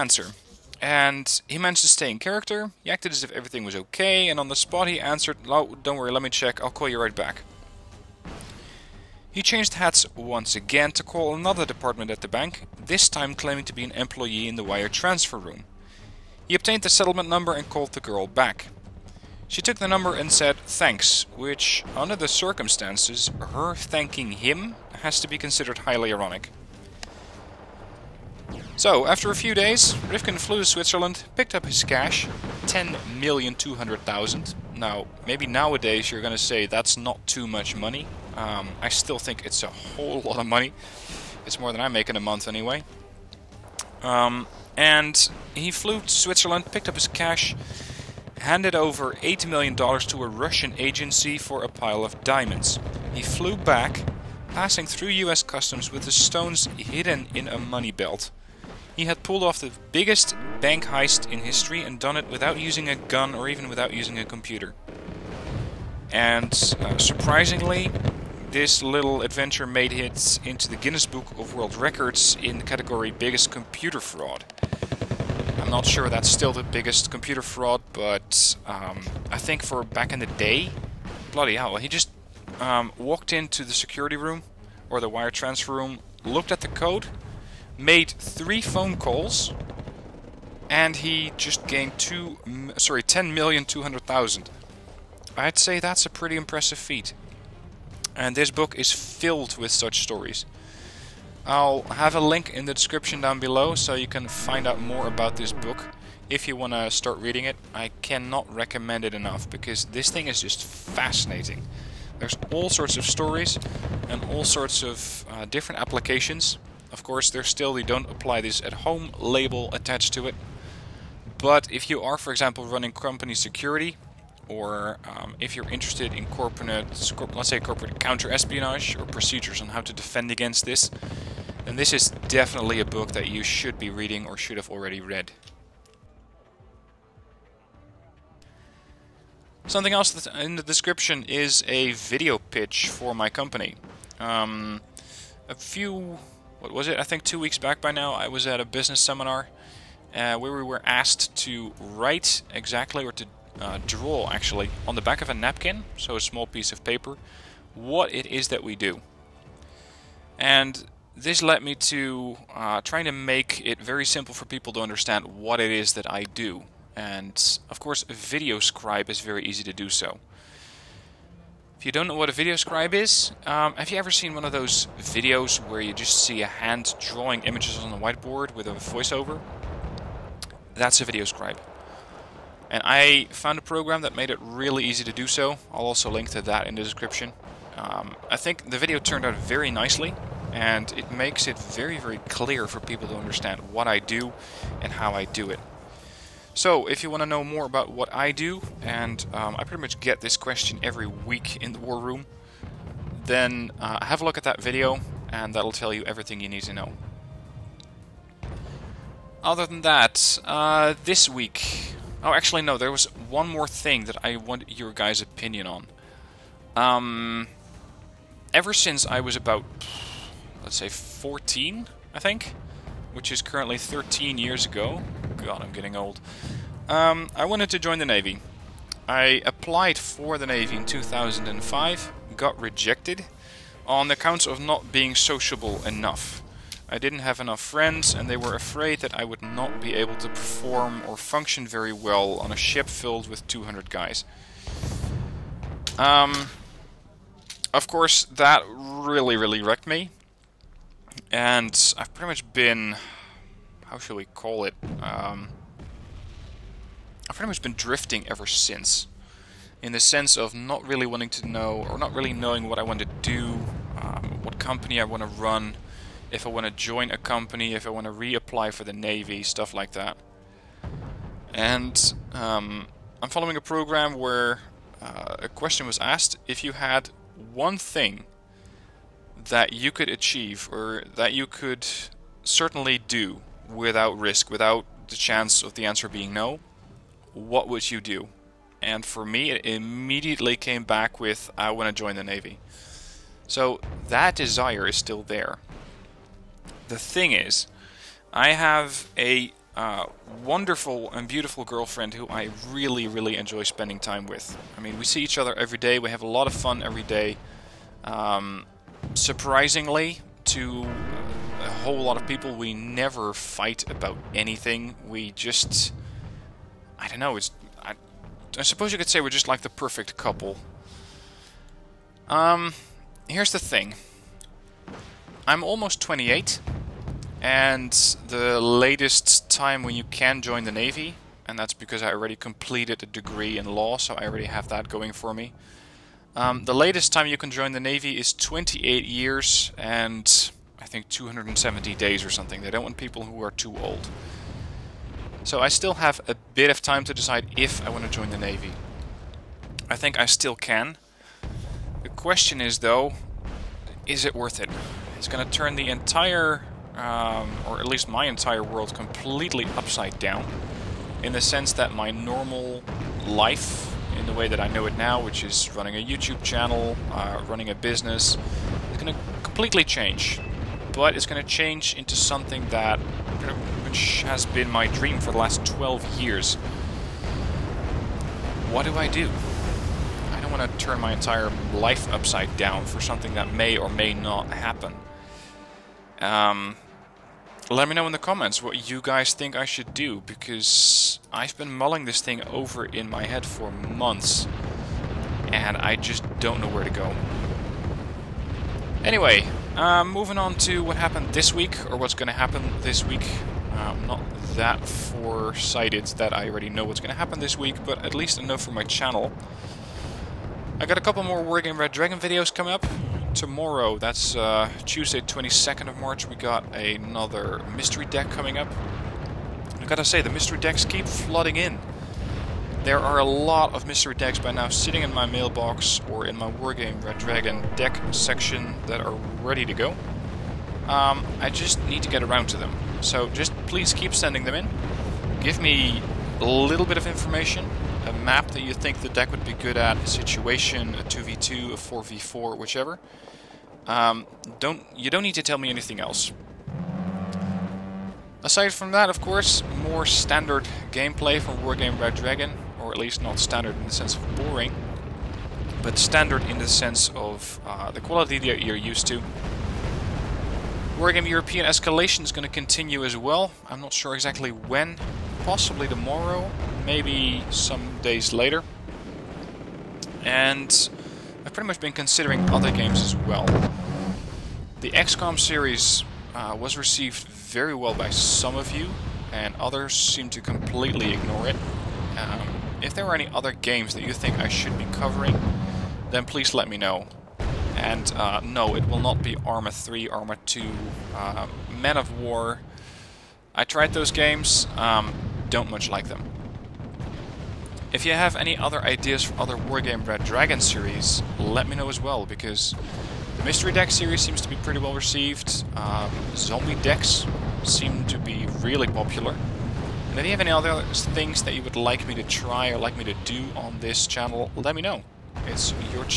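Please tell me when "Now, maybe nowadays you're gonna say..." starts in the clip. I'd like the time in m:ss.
0:34.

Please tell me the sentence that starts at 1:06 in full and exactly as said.
And uh, surprisingly, this little adventure made it into the Guinness Book of World Records in the category Biggest Computer Fraud.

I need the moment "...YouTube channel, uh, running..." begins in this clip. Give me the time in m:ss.
6:06.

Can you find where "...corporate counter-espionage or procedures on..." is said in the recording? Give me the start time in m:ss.
2:07.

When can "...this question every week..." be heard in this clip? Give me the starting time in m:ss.
3:20.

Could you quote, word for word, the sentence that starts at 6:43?
I'm um, not that foresighted that I already know what's going to happen this week, but at least enough for my channel.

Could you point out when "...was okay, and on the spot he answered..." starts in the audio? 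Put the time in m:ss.
0:03.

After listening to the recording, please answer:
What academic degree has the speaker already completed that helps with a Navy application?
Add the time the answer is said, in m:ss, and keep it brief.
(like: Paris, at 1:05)
law, at 5:33.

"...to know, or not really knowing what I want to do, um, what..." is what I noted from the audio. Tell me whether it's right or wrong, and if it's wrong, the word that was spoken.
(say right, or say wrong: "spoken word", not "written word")
right.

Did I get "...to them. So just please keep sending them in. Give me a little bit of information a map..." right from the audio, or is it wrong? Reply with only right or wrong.
right.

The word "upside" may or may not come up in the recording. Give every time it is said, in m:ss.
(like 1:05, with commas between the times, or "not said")
5:59, 6:22.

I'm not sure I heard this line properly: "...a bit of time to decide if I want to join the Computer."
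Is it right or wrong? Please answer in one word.
wrong.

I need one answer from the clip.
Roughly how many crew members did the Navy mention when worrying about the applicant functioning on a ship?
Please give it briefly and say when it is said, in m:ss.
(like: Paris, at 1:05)
200, at 4:03.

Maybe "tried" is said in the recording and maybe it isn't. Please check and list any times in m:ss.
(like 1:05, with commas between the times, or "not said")
8:13.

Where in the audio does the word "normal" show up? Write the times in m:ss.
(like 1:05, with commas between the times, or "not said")
6:02.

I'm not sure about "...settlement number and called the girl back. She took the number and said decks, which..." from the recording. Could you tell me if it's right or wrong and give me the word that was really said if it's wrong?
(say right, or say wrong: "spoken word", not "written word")
wrong: "thanks", not "decks".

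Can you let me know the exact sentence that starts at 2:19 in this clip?
Something else that's in the description is a video pitch for my company.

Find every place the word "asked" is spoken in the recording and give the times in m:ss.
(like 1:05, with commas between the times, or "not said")
2:30, 4:35.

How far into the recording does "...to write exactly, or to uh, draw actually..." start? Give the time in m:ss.
2:31.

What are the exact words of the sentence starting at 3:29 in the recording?
Other than that, uh, this week...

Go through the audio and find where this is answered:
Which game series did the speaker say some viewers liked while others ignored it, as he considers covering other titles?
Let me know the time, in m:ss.
7:54.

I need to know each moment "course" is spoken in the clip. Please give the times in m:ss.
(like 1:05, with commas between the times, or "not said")
1:57, 2:47, 4:07, 7:29.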